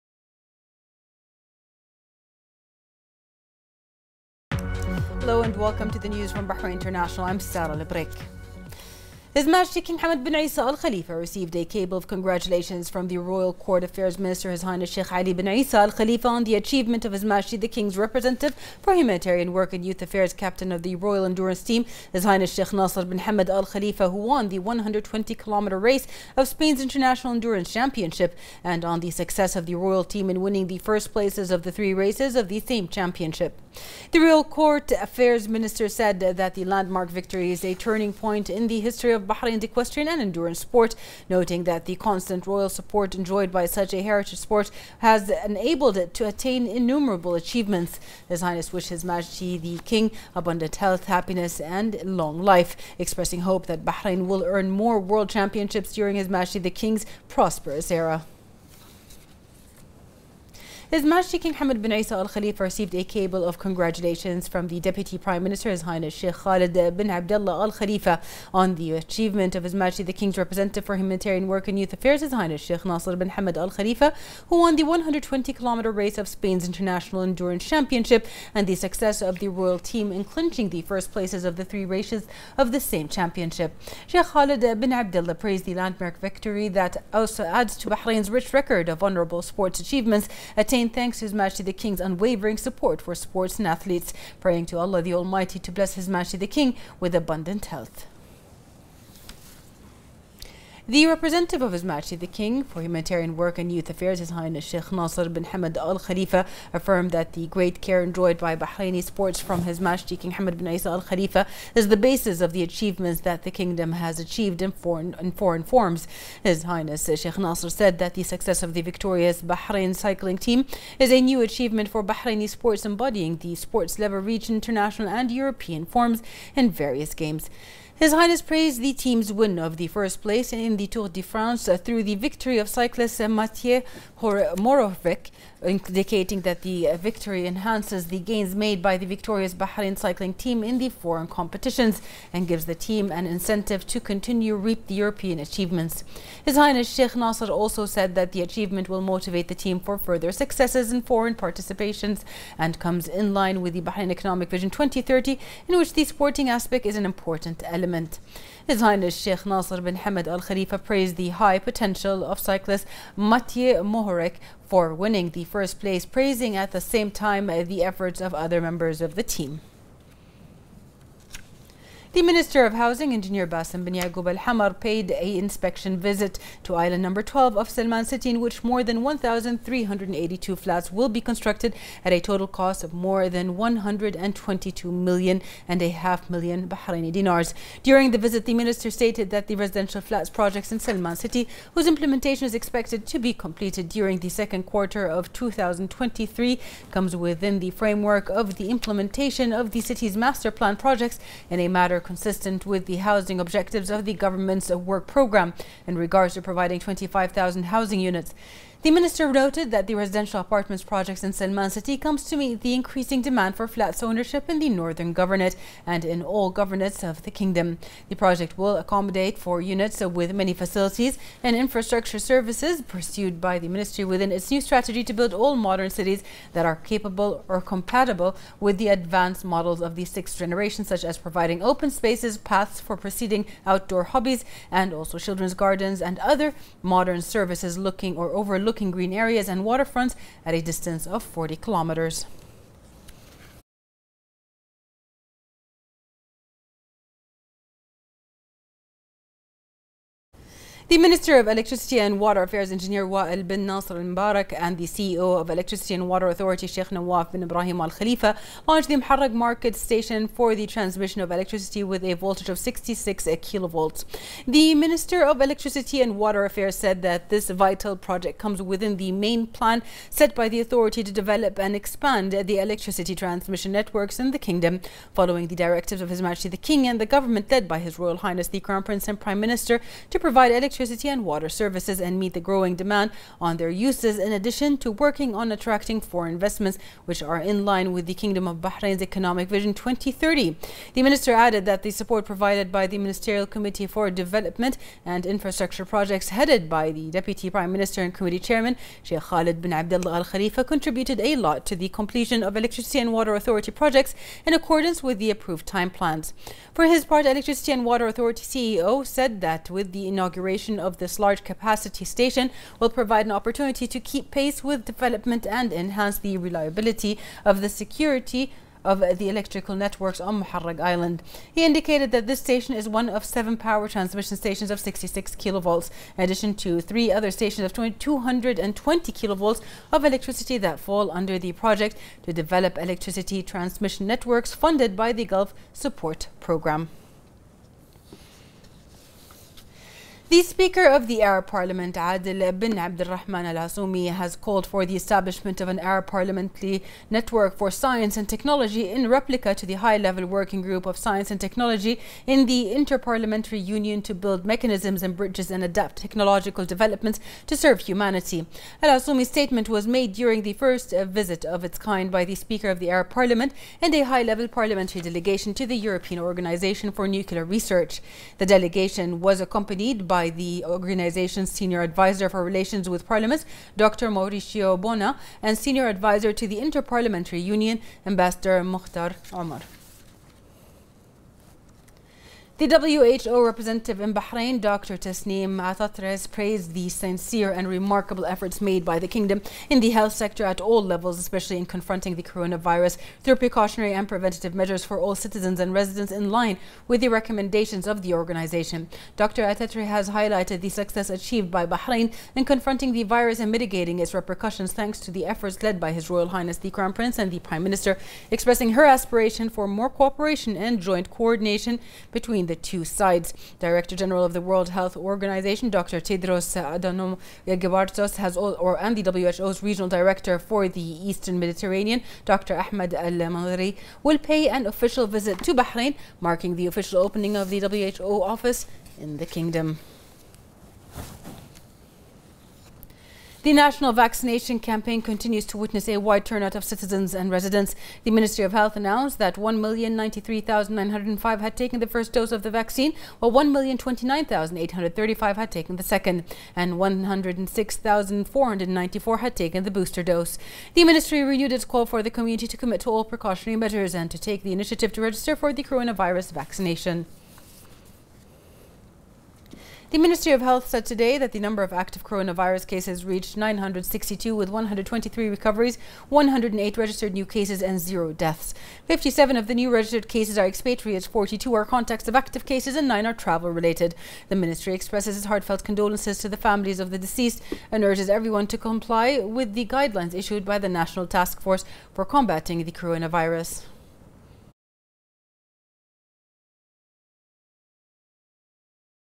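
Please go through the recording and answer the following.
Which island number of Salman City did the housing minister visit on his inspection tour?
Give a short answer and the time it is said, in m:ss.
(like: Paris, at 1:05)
12, at 2:57.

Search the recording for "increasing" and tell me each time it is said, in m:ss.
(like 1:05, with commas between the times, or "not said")
3:32.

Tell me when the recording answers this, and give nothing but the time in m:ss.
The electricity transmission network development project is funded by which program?
5:35.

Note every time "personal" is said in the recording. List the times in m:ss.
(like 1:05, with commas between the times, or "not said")
not said.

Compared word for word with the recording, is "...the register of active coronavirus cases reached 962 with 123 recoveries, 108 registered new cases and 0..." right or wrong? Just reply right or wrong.
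wrong.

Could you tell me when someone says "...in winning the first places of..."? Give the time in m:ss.
0:30.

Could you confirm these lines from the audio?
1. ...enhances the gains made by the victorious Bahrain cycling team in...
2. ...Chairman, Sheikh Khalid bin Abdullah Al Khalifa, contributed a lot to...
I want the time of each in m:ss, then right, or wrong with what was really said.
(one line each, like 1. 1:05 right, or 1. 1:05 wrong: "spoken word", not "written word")
1. 2:17 right
2. 4:58 right.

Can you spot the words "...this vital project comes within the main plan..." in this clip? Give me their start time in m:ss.
4:27.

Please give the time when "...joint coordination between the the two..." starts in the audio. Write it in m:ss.
6:50.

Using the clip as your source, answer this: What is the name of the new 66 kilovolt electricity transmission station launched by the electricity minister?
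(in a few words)
Muharraq market station.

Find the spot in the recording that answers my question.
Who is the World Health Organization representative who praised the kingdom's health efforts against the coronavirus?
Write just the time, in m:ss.
6:24.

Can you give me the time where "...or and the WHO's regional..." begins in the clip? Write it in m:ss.
6:58.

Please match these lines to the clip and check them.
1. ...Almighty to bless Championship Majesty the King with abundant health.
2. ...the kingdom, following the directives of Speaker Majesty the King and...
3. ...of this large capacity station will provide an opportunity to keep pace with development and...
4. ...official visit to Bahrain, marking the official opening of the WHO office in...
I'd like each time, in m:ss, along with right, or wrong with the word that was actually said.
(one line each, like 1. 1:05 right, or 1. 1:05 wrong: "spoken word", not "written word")
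1. 1:35 wrong: "His", not "Championship"
2. 4:34 wrong: "His", not "Speaker"
3. 5:10 right
4. 7:04 right.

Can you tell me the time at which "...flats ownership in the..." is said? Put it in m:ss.
3:33.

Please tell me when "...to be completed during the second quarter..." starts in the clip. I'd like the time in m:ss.
3:13.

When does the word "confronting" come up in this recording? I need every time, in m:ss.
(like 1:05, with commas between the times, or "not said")
6:31, 6:42.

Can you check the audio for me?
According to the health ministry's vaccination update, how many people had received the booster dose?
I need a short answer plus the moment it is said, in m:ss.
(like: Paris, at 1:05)
106,494, at 7:26.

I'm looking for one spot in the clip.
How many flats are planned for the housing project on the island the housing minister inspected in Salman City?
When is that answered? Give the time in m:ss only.
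2:59.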